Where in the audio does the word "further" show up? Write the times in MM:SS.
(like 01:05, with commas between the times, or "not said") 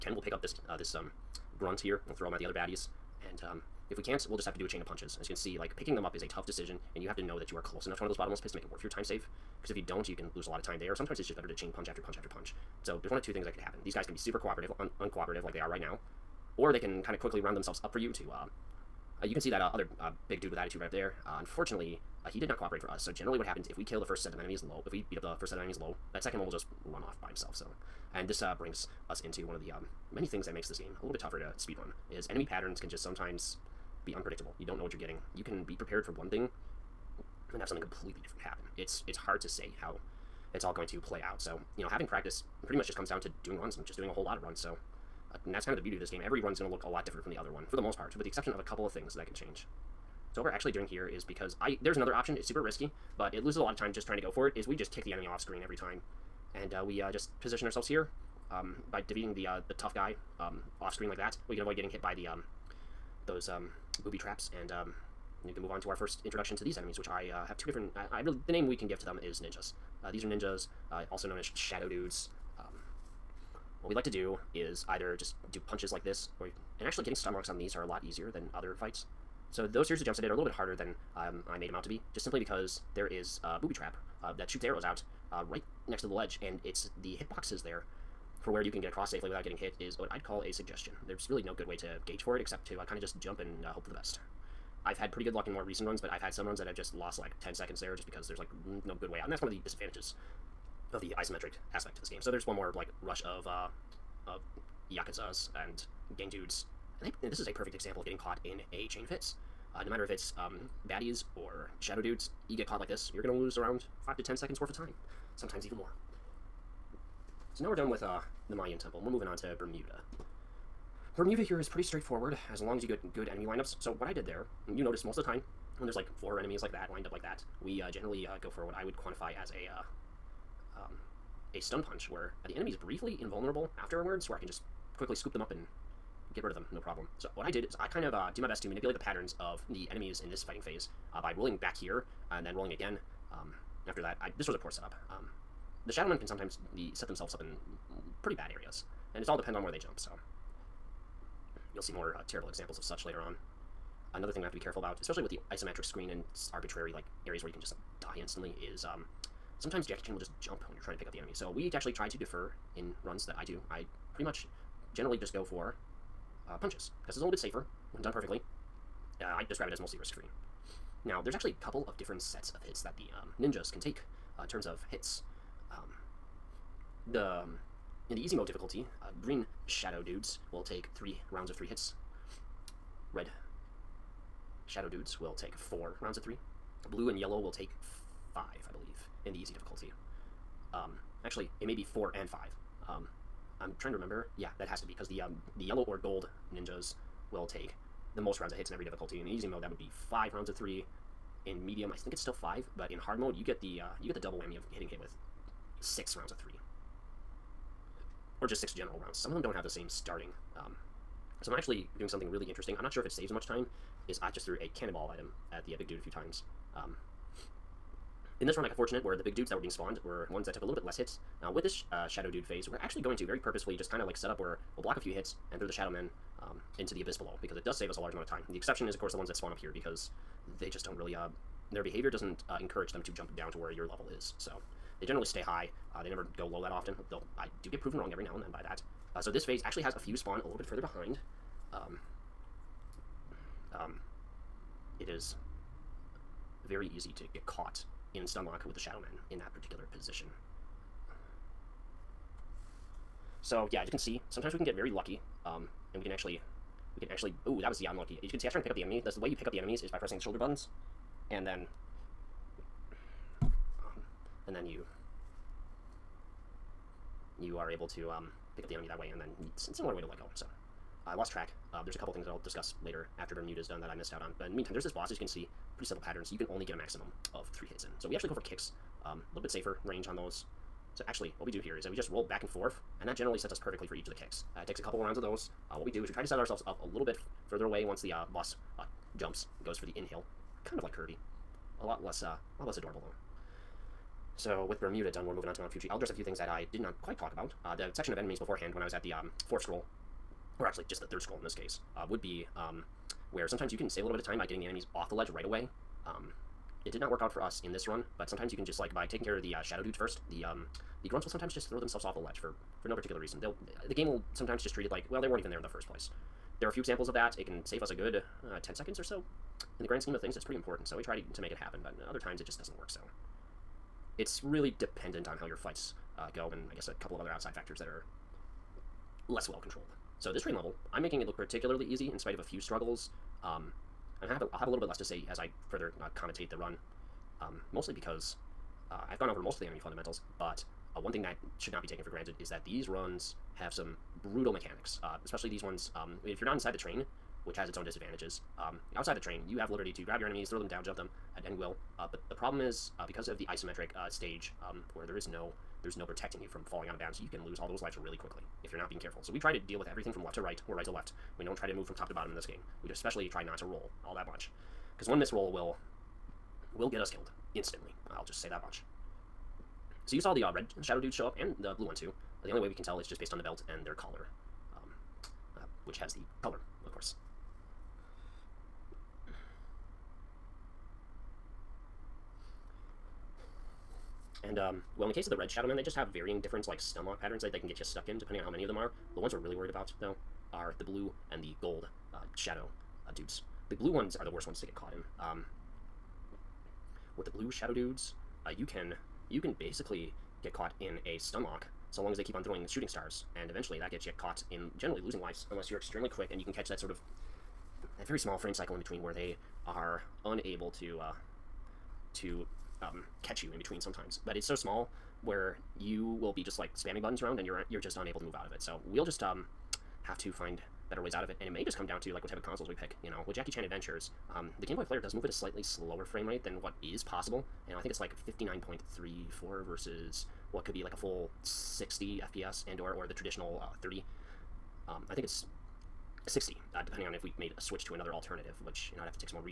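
04:00, 04:47, 05:35.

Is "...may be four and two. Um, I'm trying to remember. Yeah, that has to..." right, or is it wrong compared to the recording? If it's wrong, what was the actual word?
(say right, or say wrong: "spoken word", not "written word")
wrong: "five", not "two".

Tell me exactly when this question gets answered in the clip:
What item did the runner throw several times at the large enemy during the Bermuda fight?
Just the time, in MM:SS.
03:34.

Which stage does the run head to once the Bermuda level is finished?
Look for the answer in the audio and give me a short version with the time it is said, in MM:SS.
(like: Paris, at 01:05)
Mount Fuji, at 04:55.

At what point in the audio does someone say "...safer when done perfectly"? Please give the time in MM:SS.
02:47.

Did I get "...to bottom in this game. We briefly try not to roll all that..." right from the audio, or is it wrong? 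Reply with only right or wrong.
wrong.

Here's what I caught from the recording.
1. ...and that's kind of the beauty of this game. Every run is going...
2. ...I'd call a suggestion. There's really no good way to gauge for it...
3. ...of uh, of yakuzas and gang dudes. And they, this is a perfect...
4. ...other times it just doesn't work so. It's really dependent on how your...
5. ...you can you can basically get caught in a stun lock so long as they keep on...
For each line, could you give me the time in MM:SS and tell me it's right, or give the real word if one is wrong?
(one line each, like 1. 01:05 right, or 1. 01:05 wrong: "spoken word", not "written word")
1. 00:45 right
2. 01:30 right
3. 01:43 right
4. 05:22 right
5. 06:38 right.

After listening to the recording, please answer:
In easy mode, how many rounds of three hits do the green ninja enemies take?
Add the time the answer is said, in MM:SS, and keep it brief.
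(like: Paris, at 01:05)
3, at 03:00.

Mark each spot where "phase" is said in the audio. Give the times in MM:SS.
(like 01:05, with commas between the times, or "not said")
02:20, 03:42, 03:59.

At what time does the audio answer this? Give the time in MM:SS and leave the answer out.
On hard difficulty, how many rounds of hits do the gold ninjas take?
03:25.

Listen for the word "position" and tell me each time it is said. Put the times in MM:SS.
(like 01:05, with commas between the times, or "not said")
00:57, 04:09.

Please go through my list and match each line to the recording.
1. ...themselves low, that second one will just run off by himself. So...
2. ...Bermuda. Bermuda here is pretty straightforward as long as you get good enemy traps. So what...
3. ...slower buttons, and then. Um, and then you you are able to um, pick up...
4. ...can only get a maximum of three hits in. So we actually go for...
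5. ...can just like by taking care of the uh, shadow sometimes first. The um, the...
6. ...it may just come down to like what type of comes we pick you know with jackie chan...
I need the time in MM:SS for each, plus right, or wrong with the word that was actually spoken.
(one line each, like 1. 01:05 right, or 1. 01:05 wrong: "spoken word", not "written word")
1. 00:25 wrong: "enemies", not "themselves"
2. 01:59 wrong: "lineups", not "traps"
3. 04:20 wrong: "shoulder", not "slower"
4. 04:36 right
5. 05:08 wrong: "dudes", not "sometimes"
6. 07:01 wrong: "consoles", not "comes".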